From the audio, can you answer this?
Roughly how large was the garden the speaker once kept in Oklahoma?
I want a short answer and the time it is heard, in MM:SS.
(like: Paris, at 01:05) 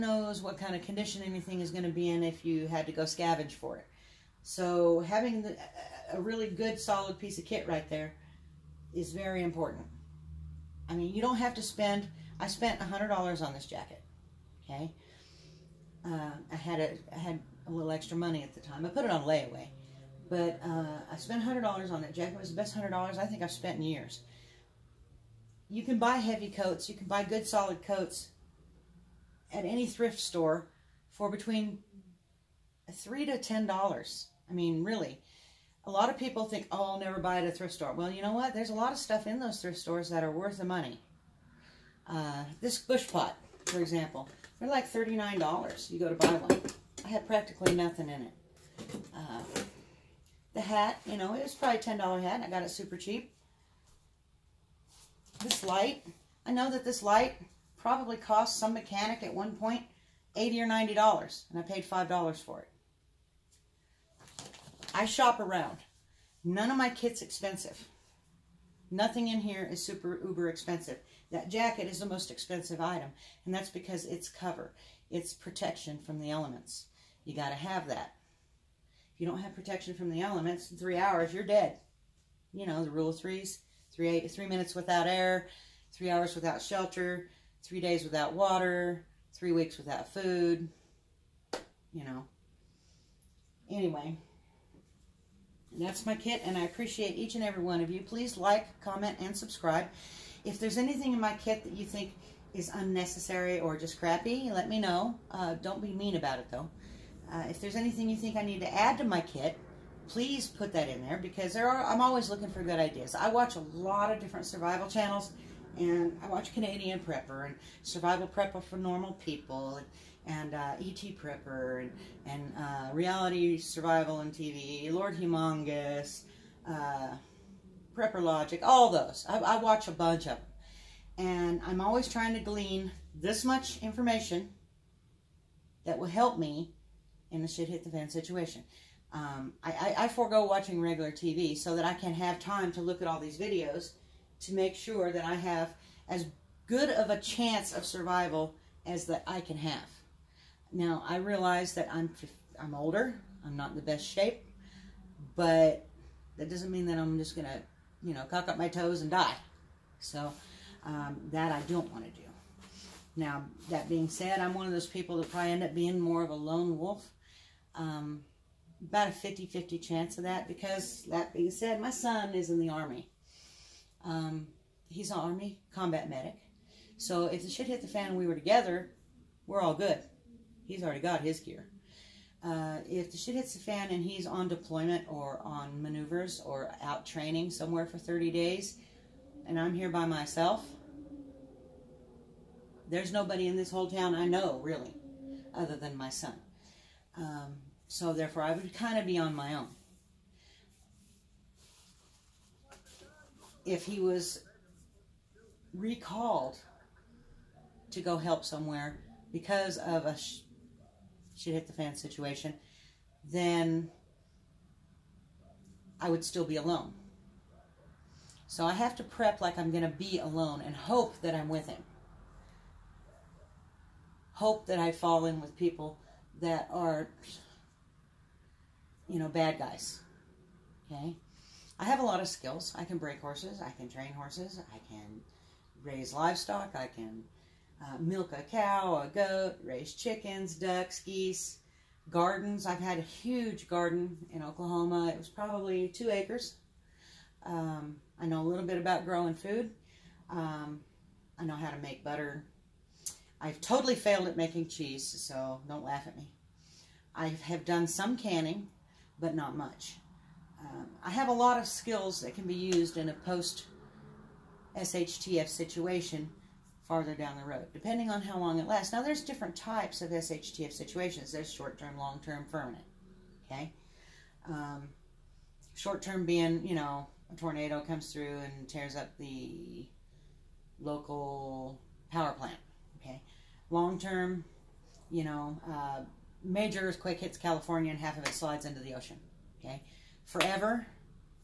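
2 acres, at 04:05.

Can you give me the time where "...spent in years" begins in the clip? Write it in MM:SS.
00:23.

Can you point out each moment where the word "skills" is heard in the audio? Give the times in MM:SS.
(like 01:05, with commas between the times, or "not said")
03:52, 04:21.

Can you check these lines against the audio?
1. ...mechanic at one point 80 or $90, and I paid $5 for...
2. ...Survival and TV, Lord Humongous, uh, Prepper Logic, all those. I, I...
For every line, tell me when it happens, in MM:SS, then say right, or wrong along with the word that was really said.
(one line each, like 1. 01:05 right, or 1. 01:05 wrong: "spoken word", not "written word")
1. 00:58 right
2. 02:03 right.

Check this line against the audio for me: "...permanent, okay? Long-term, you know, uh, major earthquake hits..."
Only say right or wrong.
wrong.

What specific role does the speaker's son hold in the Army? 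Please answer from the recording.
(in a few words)
combat medic.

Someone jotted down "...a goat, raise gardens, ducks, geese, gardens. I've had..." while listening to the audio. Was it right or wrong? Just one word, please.
wrong.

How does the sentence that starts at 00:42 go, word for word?
Uh, this bush pot, for example, they're like $39.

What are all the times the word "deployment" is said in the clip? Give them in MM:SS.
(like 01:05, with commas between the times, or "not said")
03:04.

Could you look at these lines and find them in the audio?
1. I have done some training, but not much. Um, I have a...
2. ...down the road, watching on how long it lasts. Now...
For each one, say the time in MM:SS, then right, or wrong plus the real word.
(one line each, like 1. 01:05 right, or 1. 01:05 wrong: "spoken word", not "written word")
1. 04:17 wrong: "canning", not "training"
2. 04:27 wrong: "depending", not "watching".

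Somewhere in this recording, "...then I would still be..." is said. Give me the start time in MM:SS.
03:33.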